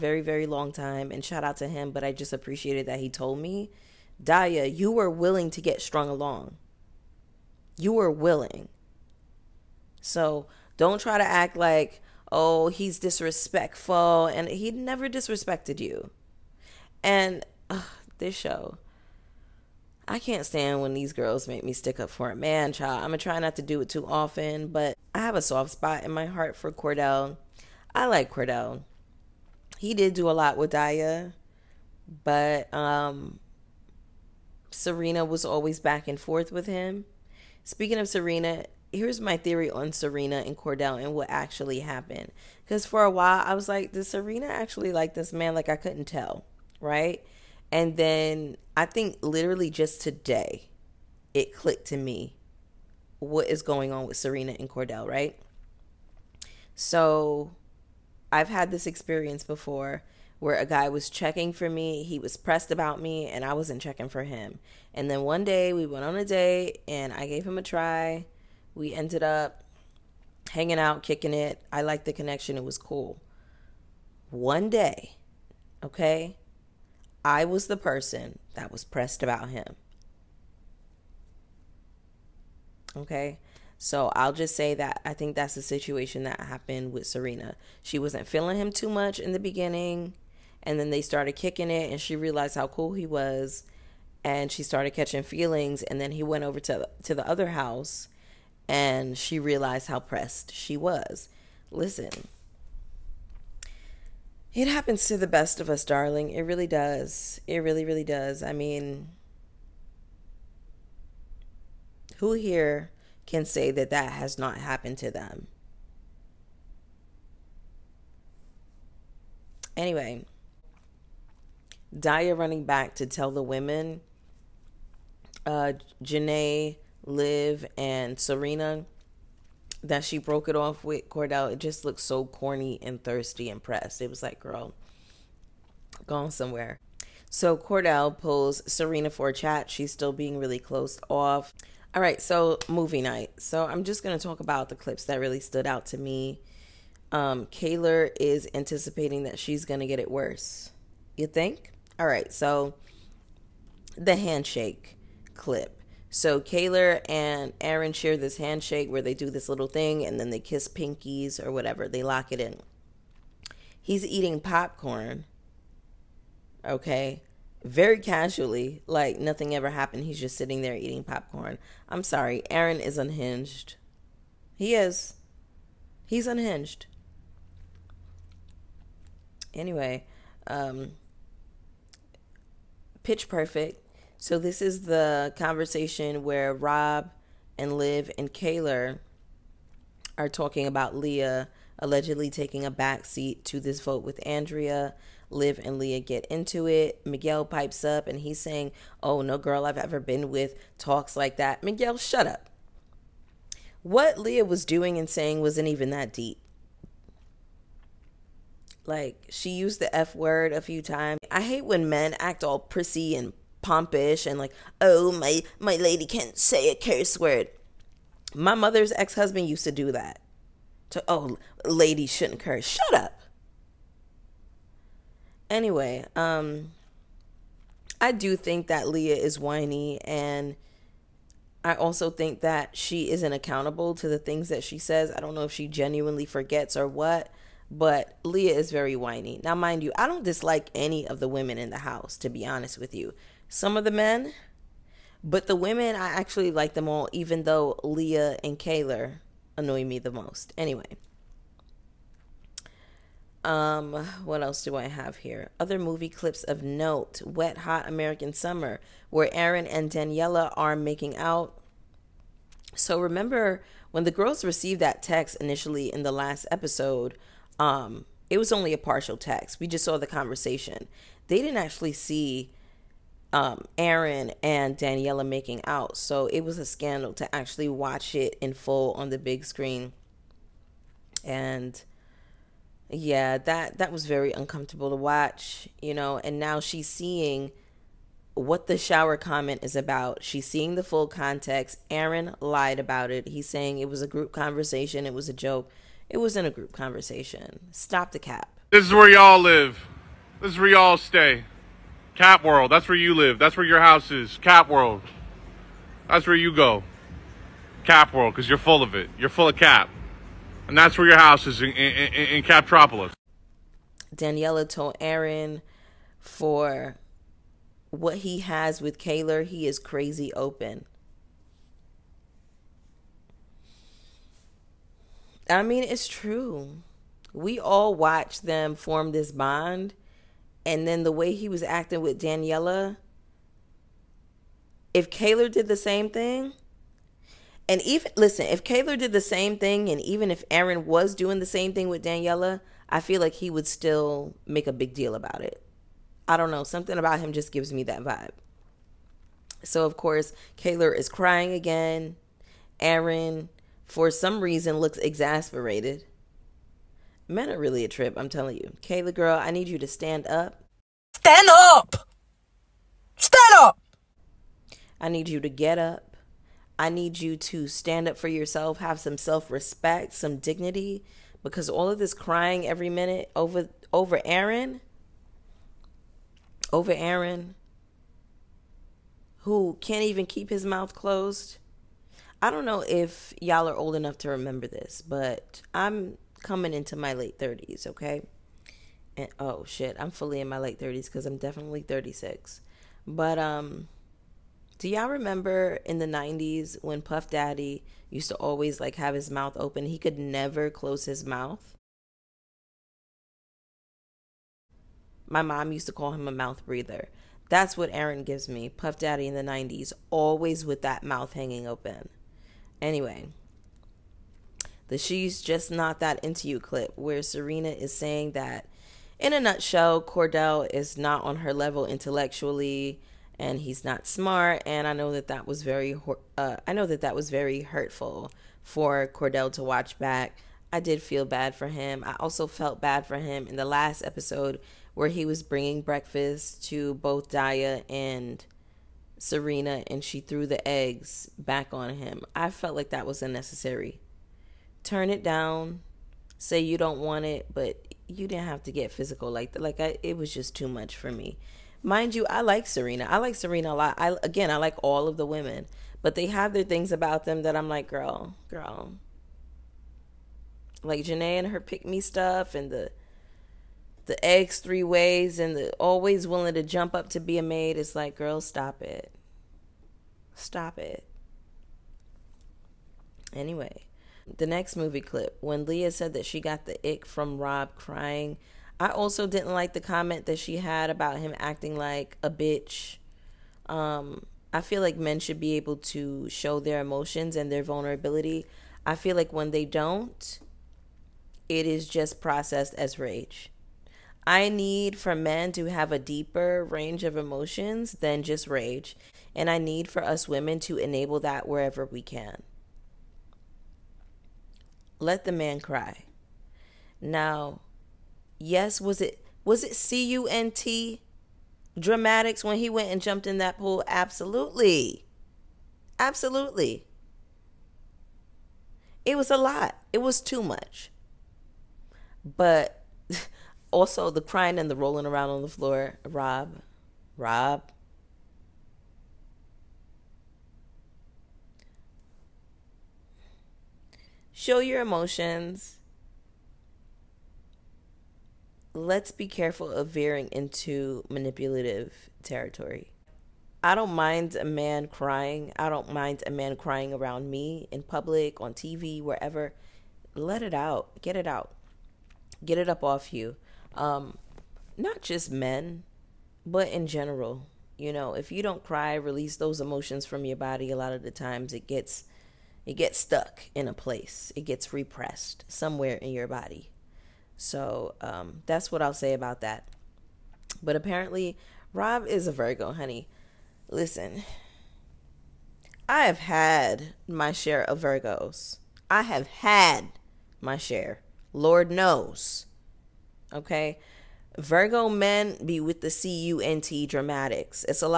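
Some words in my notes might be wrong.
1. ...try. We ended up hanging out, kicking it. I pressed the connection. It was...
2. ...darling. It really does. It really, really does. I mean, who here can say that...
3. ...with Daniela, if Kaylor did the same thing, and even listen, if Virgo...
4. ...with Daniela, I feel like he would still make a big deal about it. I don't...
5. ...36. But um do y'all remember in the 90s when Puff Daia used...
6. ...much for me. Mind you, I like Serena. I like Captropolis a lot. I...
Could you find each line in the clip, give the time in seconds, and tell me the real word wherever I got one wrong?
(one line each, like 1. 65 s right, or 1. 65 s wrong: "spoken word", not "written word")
1. 67 s wrong: "liked", not "pressed"
2. 105 s right
3. 332 s wrong: "Kaylor", not "Virgo"
4. 341 s right
5. 391 s wrong: "Daddy", not "Daia"
6. 450 s wrong: "Serena", not "Captropolis".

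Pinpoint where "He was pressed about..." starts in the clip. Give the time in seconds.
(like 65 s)
62 s.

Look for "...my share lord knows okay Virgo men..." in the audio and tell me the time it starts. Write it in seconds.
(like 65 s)
580 s.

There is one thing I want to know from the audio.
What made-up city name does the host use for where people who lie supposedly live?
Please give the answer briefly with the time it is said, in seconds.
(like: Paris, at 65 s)
Captropolis, at 312 s.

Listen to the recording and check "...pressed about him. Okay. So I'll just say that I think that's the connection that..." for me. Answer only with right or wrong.
wrong.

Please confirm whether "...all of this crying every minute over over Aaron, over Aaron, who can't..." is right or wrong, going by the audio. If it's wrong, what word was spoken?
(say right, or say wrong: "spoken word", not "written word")
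right.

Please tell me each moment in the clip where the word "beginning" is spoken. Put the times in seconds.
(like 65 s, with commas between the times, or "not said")
89 s.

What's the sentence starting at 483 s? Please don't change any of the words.
Um, I feel like men should be able to show their emotions and their vulnerability.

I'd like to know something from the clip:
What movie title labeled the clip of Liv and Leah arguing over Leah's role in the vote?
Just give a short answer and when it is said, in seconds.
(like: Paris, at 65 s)
Pitch Perfect, at 183 s.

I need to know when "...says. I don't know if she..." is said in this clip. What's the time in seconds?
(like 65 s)
234 s.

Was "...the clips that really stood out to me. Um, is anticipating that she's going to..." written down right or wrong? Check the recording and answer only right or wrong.
right.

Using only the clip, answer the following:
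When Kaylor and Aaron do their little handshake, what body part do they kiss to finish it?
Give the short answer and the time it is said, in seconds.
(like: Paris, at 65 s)
Pinkies, at 160 s.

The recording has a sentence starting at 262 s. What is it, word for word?
So remember when the girls received that text initially in the last episode, um, it was only a partial text.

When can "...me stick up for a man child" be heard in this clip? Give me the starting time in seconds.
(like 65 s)
21 s.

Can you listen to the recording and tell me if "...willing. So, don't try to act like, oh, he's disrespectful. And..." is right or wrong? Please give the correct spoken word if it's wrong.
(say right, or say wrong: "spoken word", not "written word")
right.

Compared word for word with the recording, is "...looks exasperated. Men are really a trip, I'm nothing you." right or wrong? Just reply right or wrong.
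wrong.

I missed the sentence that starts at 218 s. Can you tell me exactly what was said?
My mother's ex husband used to do that.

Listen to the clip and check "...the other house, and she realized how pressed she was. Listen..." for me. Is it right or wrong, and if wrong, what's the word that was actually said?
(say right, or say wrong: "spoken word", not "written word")
right.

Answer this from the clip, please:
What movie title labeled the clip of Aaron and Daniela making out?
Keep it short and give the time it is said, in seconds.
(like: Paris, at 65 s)
Wet Hot American Summer, at 257 s.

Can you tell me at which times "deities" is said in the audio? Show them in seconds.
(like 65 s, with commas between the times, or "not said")
not said.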